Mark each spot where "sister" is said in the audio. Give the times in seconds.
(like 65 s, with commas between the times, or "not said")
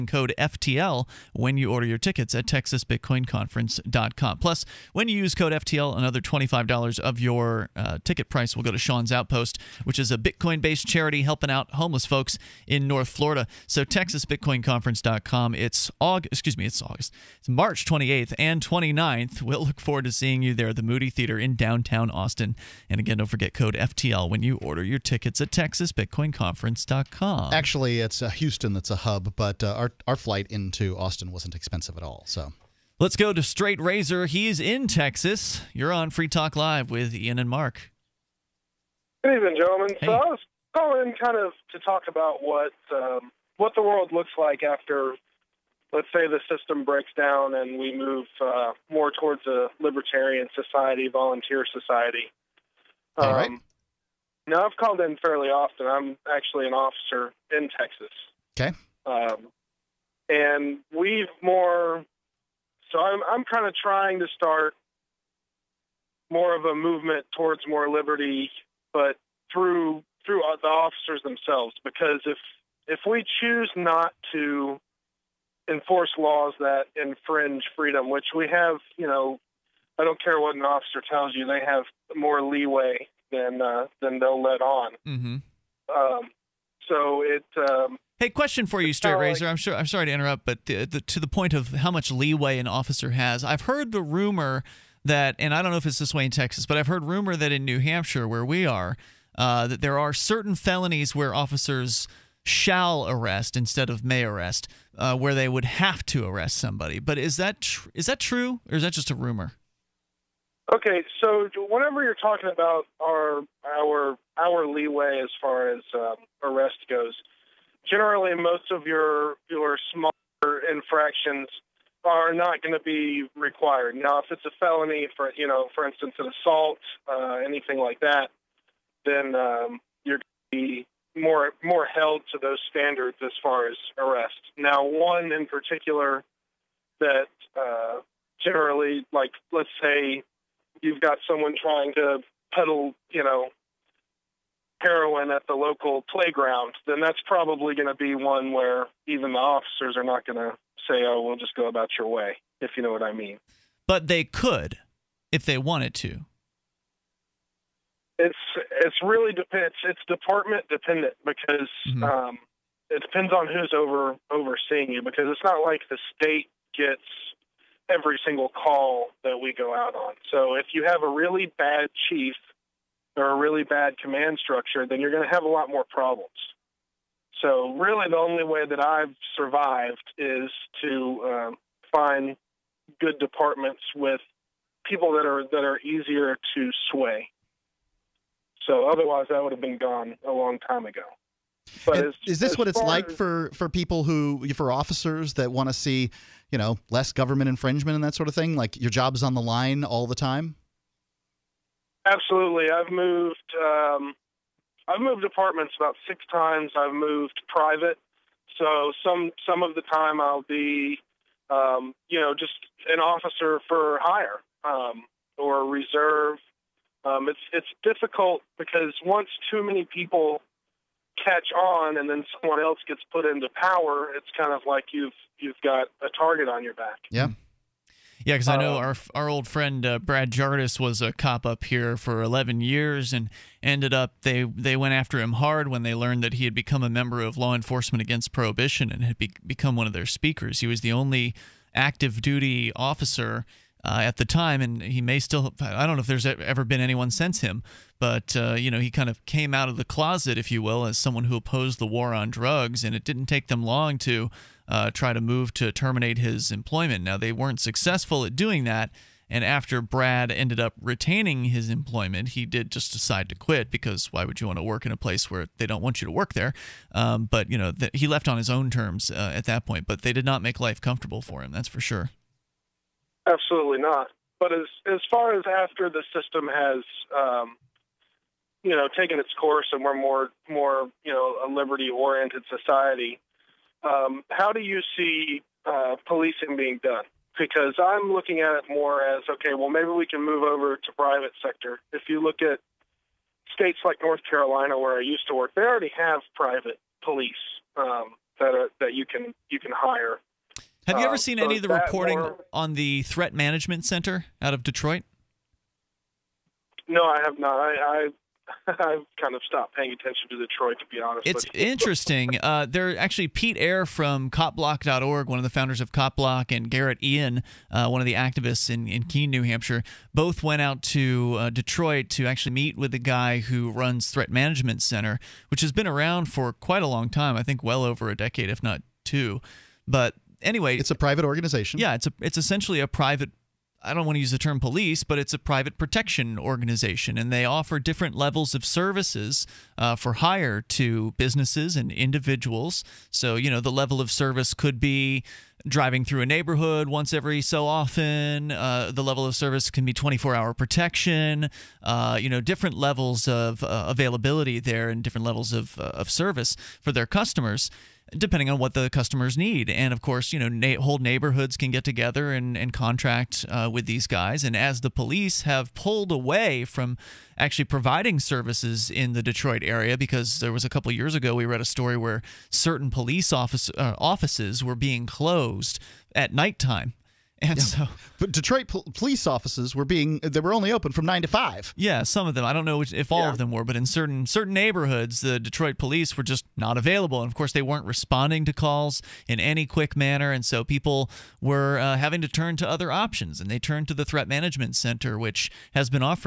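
not said.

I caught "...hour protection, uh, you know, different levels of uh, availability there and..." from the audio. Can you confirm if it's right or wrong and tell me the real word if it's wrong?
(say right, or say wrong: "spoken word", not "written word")
right.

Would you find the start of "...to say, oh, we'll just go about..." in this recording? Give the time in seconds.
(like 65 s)
150 s.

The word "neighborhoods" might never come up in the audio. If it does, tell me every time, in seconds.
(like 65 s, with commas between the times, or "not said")
346 s, 360 s, 384 s.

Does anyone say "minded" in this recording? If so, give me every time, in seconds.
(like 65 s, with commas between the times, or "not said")
not said.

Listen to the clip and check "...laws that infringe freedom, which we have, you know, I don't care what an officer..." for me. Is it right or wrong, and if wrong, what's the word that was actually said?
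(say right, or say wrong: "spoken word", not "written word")
right.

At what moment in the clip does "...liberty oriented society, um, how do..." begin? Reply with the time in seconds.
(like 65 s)
281 s.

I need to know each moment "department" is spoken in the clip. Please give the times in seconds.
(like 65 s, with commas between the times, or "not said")
160 s, 183 s.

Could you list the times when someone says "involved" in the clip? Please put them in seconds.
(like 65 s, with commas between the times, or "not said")
not said.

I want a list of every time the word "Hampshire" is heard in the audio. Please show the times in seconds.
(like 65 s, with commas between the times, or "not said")
97 s, 319 s.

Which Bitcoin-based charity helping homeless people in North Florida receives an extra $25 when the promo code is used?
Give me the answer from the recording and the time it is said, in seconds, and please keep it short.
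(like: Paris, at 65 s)
Sean's Outpost, at 8 s.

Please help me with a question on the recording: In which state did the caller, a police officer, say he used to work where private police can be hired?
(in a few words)
North Carolina.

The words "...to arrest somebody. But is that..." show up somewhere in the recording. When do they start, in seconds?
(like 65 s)
106 s.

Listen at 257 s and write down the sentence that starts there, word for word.
Now, they weren't successful at doing that.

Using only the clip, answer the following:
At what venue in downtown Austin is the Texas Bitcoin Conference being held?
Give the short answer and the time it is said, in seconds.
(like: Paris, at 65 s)
Moody Theater, at 20 s.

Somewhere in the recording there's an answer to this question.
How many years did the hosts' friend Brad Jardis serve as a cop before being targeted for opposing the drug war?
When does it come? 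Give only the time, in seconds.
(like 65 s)
232 s.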